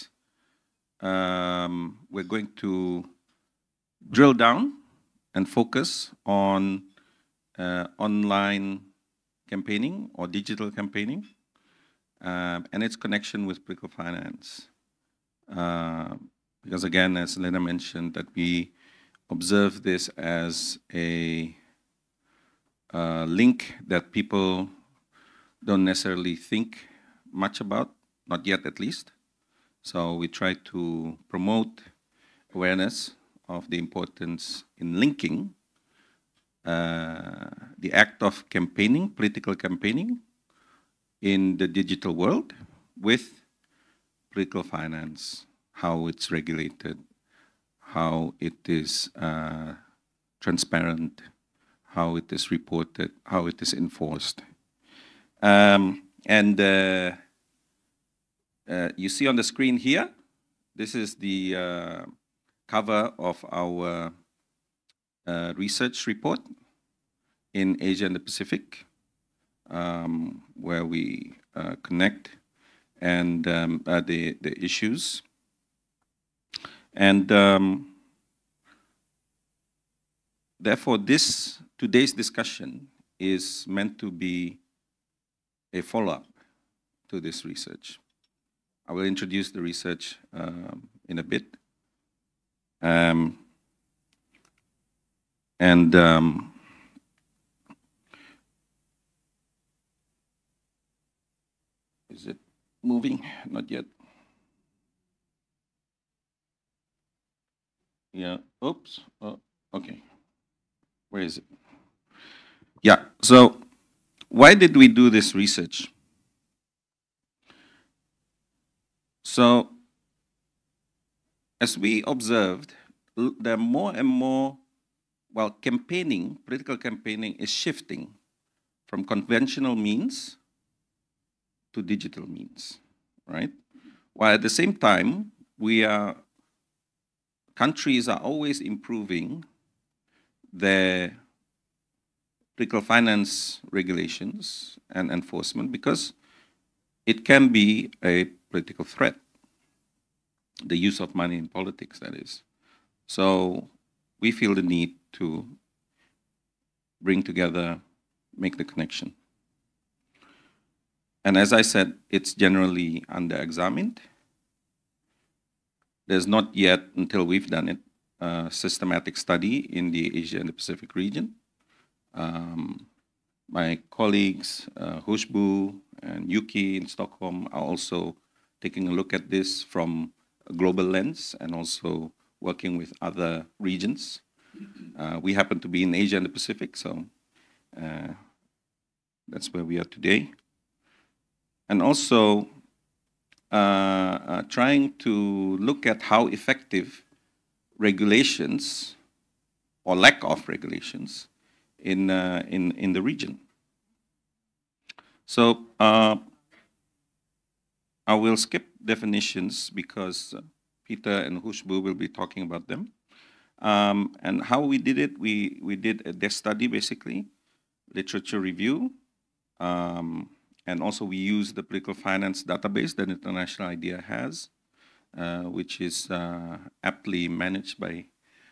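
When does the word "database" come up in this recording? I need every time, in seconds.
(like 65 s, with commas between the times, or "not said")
222 s.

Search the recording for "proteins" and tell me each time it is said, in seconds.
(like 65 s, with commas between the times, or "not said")
not said.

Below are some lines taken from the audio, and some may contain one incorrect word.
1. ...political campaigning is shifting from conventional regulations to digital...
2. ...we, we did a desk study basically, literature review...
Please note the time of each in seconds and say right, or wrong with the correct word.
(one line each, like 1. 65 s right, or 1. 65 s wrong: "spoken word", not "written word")
1. 126 s wrong: "means", not "regulations"
2. 215 s right.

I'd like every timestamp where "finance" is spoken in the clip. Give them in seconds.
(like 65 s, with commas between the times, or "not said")
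13 s, 44 s, 142 s, 221 s.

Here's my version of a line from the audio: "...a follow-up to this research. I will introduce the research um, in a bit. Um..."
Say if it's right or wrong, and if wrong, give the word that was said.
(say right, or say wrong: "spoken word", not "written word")
right.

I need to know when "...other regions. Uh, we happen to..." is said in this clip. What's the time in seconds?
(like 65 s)
183 s.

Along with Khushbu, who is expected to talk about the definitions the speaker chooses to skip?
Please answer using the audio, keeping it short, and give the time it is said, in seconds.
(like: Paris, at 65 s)
Peter, at 210 s.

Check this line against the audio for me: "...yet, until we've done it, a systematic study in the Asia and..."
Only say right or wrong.
right.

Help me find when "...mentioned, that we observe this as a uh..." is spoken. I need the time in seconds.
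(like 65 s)
17 s.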